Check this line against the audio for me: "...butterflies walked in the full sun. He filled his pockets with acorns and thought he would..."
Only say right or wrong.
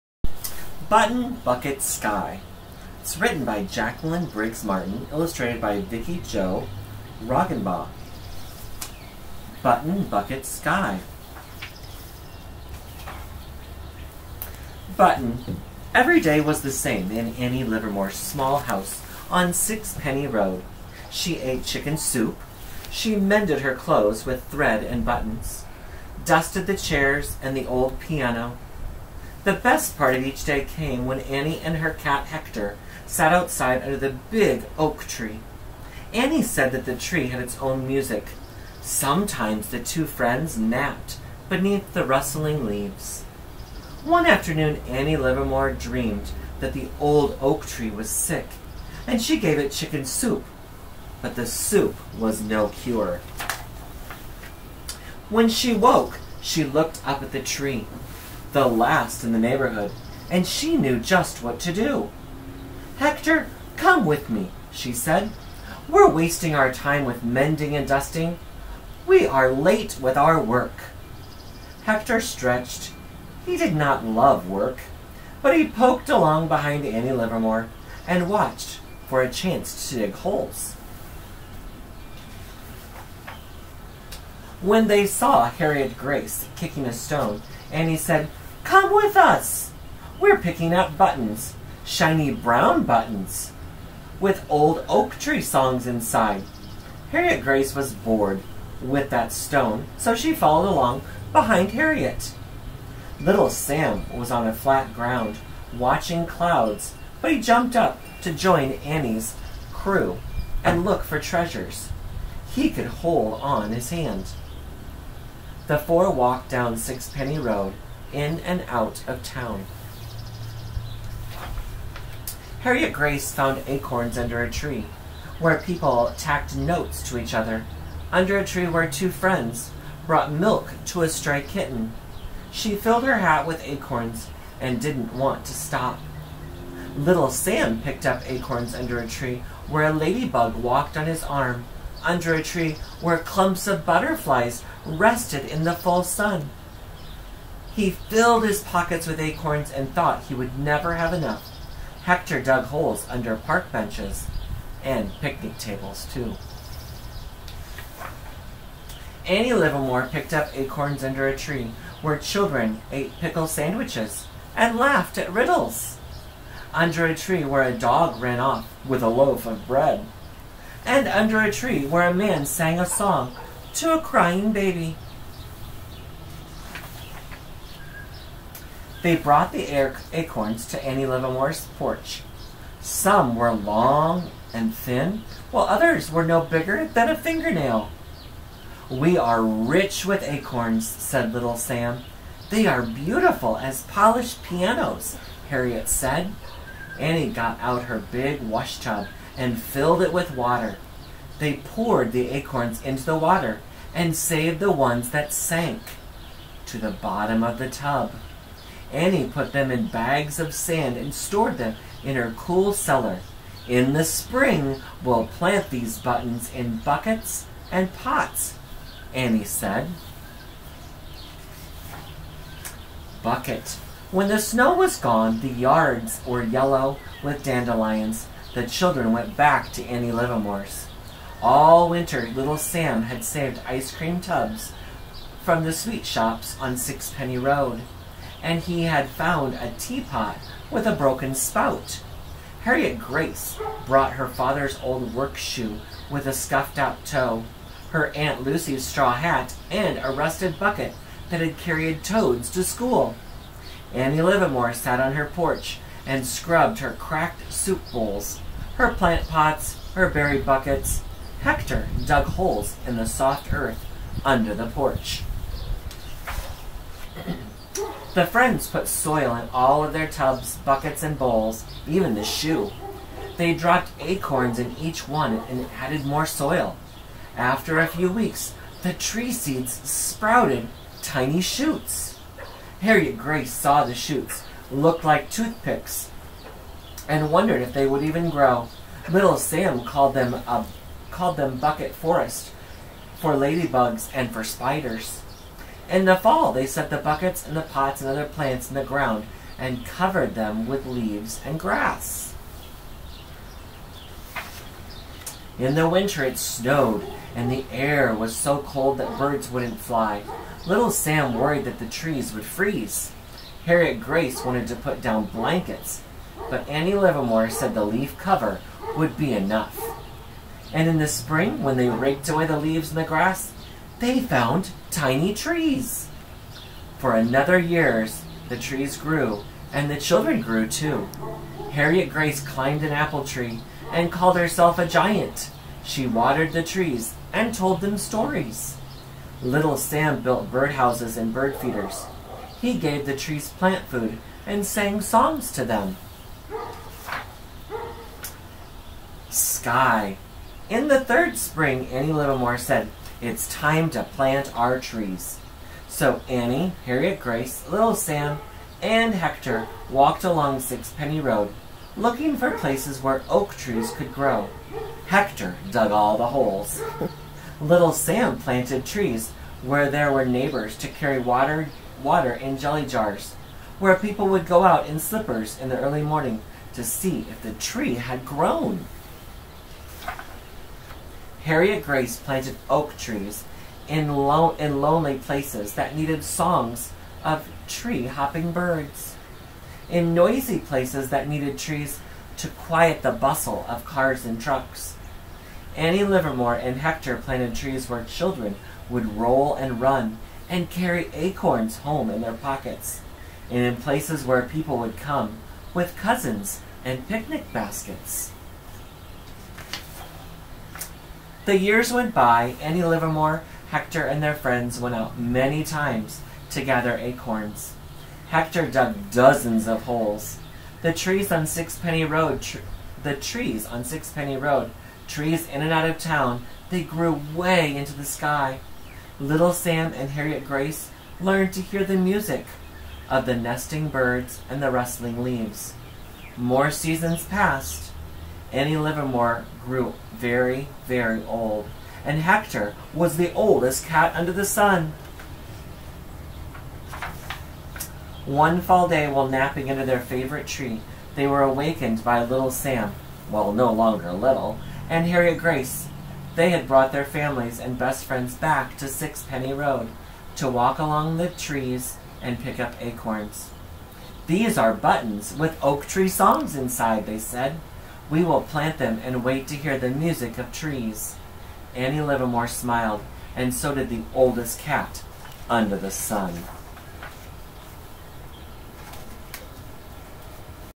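wrong.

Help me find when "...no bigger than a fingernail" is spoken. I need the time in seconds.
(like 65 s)
186 s.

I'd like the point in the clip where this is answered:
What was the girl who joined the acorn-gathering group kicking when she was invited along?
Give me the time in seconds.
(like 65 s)
86 s.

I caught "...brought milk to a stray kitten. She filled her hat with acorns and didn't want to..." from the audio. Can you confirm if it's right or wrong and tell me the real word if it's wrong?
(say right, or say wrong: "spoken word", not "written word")
right.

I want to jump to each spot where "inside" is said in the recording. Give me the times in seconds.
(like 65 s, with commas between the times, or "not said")
95 s, 466 s.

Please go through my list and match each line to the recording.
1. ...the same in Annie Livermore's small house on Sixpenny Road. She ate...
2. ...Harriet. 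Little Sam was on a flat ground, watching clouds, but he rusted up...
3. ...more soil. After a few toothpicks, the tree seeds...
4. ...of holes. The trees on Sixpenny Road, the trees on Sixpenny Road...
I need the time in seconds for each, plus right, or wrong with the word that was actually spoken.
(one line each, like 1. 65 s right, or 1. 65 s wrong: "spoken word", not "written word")
1. 16 s right
2. 101 s wrong: "jumped", not "rusted"
3. 276 s wrong: "weeks", not "toothpicks"
4. 419 s right.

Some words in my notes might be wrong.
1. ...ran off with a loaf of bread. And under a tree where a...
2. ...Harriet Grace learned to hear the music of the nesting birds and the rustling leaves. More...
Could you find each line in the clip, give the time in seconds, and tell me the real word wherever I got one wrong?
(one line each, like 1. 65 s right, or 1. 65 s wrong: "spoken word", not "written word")
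1. 168 s right
2. 430 s right.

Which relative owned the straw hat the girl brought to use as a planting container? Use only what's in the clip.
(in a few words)
Aunt Lucy.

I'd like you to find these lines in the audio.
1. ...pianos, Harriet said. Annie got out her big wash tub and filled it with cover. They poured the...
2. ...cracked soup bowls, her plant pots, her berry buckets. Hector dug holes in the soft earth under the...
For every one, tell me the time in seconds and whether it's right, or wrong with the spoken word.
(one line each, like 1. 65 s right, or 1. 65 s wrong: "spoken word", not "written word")
1. 194 s wrong: "water", not "cover"
2. 256 s right.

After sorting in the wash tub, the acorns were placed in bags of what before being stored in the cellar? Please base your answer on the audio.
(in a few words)
sand.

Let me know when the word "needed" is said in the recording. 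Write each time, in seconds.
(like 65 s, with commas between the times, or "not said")
385 s, 391 s.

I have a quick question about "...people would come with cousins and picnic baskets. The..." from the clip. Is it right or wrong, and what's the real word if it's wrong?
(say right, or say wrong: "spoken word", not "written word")
right.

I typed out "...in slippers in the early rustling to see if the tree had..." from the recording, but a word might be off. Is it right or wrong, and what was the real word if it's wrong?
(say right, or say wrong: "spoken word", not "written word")
wrong: "morning", not "rustling".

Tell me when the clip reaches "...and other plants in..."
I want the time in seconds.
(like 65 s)
297 s.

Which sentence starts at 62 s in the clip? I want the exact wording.
Hector, come with me, she said.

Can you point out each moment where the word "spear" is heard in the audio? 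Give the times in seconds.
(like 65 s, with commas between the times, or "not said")
not said.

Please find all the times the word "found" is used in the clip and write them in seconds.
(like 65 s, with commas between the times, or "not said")
123 s, 239 s, 324 s.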